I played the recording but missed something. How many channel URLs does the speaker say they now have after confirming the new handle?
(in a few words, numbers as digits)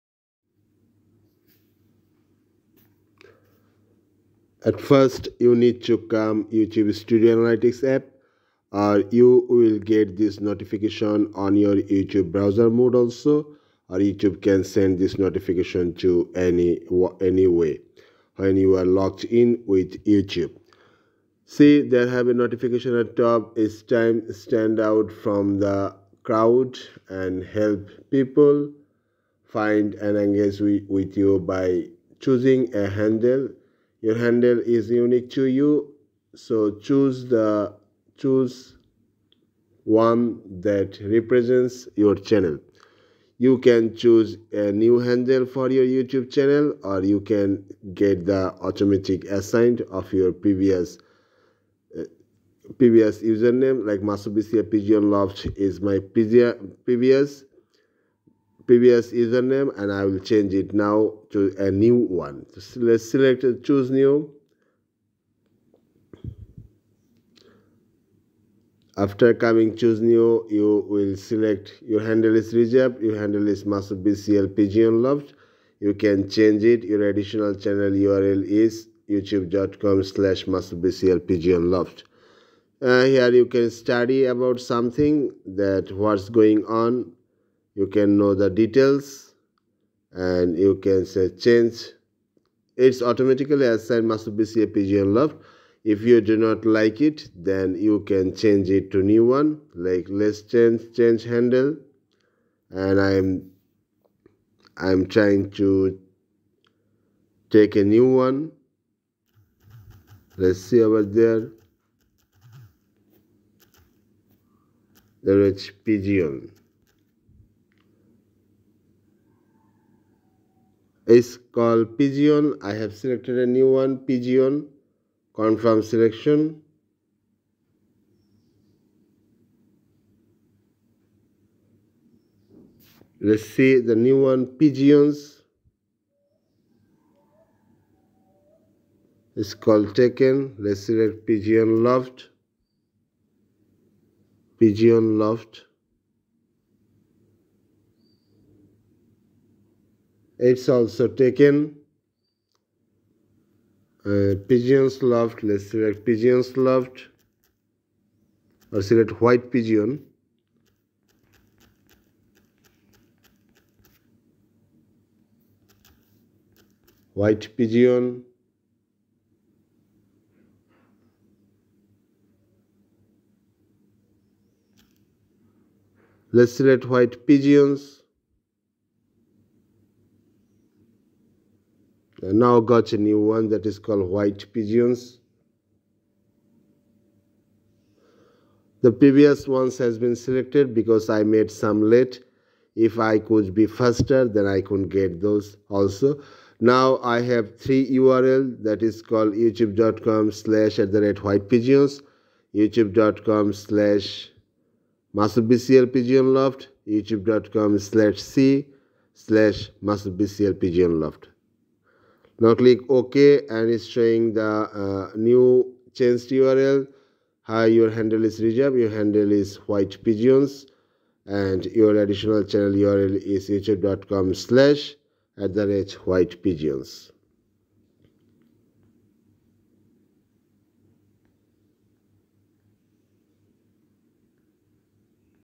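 3.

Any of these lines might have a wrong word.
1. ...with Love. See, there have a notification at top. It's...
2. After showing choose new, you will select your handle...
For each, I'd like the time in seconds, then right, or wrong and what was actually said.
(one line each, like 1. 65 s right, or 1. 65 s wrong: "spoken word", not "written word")
1. 19 s wrong: "YouTube", not "Love"
2. 68 s wrong: "coming", not "showing".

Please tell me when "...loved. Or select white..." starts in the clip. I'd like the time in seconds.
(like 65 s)
156 s.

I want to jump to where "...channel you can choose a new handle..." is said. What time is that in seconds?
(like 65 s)
42 s.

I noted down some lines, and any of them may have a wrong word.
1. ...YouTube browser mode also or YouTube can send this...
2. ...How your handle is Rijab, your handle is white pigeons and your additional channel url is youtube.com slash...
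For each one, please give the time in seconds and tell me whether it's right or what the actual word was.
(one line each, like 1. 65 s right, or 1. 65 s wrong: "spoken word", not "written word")
1. 11 s right
2. 217 s right.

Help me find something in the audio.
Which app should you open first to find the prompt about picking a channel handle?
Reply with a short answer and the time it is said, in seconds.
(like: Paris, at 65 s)
YouTube Studio Analytics, at 6 s.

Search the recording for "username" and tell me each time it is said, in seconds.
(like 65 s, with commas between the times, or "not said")
53 s, 59 s.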